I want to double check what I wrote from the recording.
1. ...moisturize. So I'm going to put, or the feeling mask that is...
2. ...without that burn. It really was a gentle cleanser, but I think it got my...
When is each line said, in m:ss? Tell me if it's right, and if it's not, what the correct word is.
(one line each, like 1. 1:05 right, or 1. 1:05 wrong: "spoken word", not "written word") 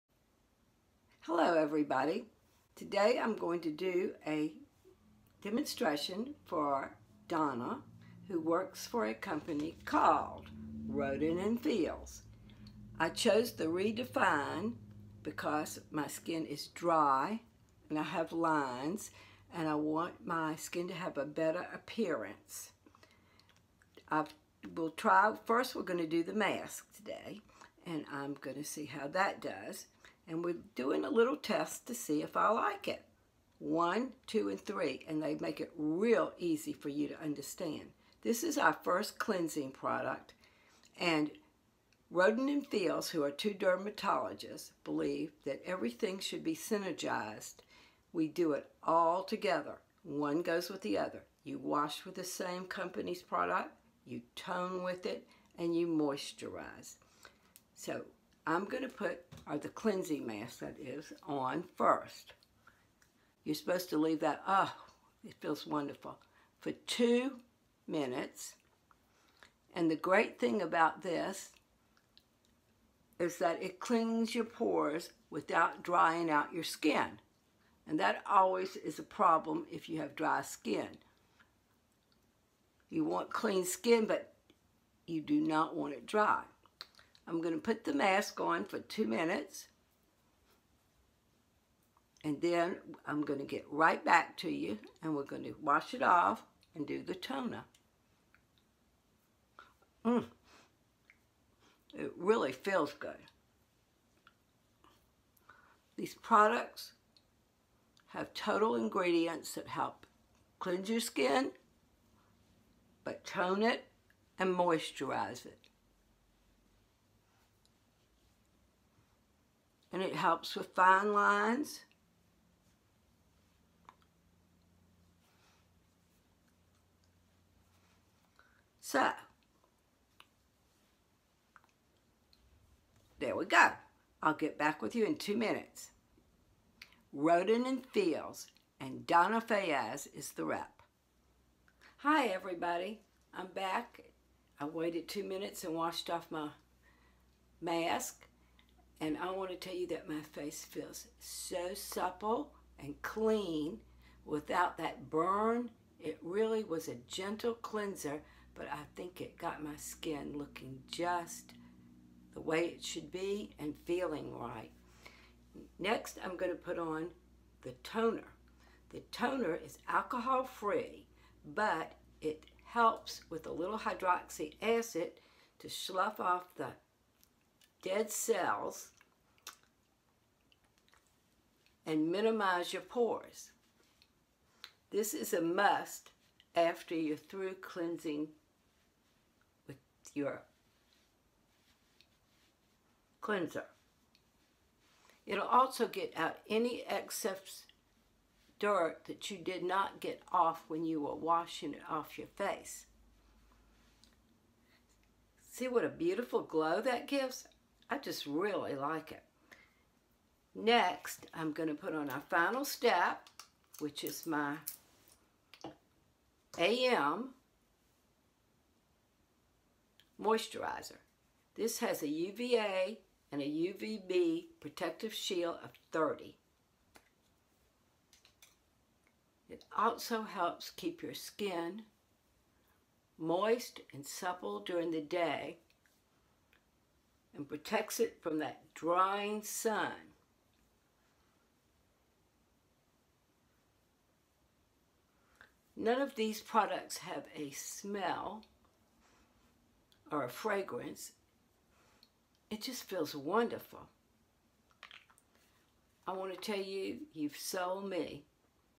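1. 0:55 wrong: "cleansing", not "feeling"
2. 2:34 right.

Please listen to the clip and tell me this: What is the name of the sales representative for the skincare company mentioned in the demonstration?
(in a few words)
Donna Fayyaz.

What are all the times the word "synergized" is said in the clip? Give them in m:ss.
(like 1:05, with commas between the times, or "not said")
0:46.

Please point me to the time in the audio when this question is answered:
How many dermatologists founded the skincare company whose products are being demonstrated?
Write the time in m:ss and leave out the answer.
0:43.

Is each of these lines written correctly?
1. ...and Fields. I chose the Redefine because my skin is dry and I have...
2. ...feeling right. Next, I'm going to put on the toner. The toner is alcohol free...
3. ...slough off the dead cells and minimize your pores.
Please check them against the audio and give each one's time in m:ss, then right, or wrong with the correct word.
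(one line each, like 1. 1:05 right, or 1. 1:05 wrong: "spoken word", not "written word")
1. 0:11 right
2. 2:43 right
3. 2:55 right.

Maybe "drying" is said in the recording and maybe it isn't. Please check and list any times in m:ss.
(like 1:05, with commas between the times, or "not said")
1:15, 3:58.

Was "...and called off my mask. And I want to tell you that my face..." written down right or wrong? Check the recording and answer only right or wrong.
wrong.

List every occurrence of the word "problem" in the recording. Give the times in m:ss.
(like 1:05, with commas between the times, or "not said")
1:19.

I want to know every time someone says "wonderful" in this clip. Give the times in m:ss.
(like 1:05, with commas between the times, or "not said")
1:05, 4:13.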